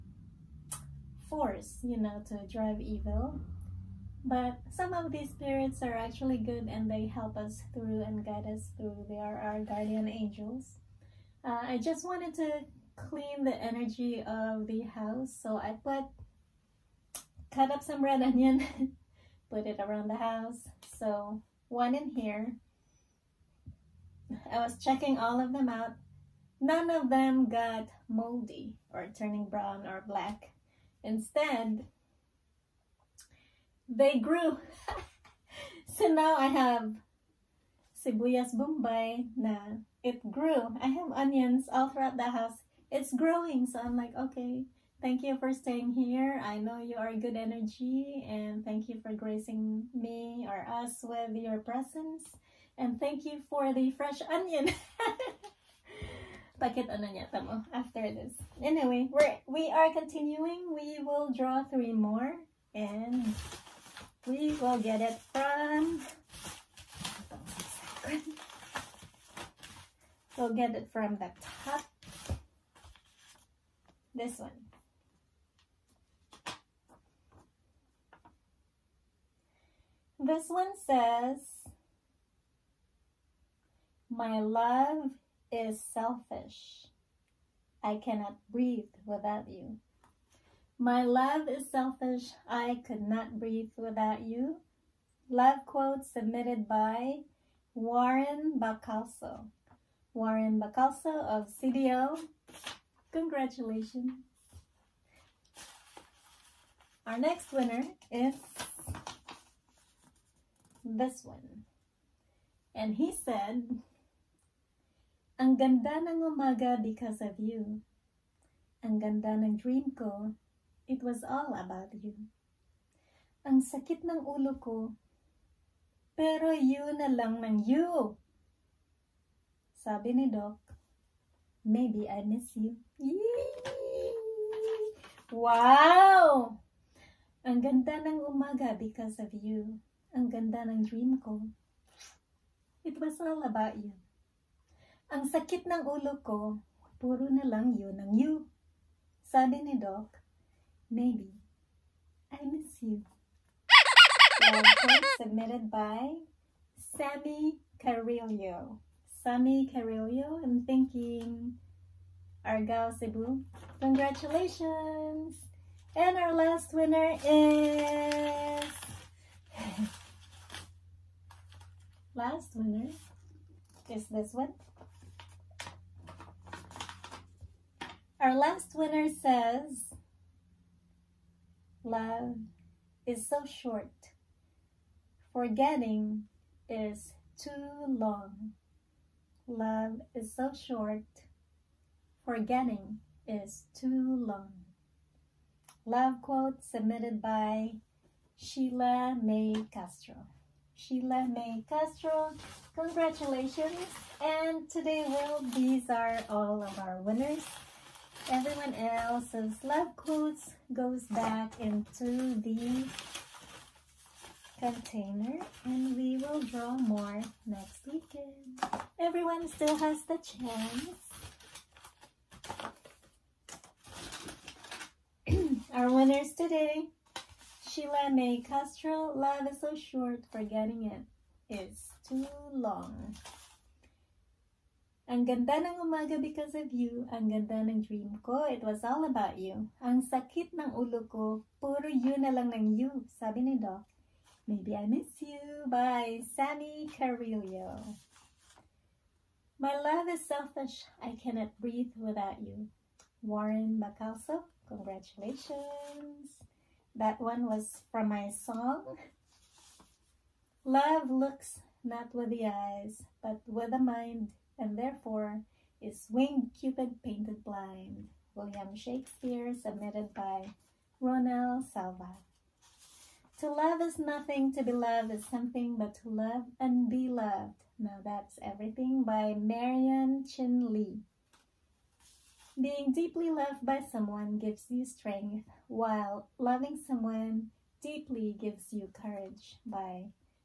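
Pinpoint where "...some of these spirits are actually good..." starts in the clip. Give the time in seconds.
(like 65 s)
4 s.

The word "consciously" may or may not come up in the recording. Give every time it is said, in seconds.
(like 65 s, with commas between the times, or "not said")
not said.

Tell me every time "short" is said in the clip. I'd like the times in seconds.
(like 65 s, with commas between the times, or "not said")
183 s, 190 s, 229 s.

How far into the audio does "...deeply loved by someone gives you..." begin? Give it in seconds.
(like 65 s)
282 s.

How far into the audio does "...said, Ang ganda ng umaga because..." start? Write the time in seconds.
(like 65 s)
113 s.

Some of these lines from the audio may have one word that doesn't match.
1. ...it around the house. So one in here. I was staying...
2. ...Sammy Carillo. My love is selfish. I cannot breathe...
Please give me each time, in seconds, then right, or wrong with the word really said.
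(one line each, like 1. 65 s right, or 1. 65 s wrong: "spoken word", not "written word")
1. 19 s wrong: "checking", not "staying"
2. 246 s right.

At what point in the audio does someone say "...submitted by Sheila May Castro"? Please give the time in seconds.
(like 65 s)
196 s.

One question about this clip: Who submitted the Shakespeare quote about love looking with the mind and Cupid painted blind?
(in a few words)
Ronel Salva.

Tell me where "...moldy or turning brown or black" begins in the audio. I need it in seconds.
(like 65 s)
28 s.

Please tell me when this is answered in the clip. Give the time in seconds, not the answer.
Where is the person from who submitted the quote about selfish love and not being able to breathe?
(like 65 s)
101 s.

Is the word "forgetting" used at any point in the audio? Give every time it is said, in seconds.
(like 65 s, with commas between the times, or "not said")
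185 s, 192 s, 230 s.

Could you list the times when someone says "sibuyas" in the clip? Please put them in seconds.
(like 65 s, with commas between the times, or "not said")
38 s.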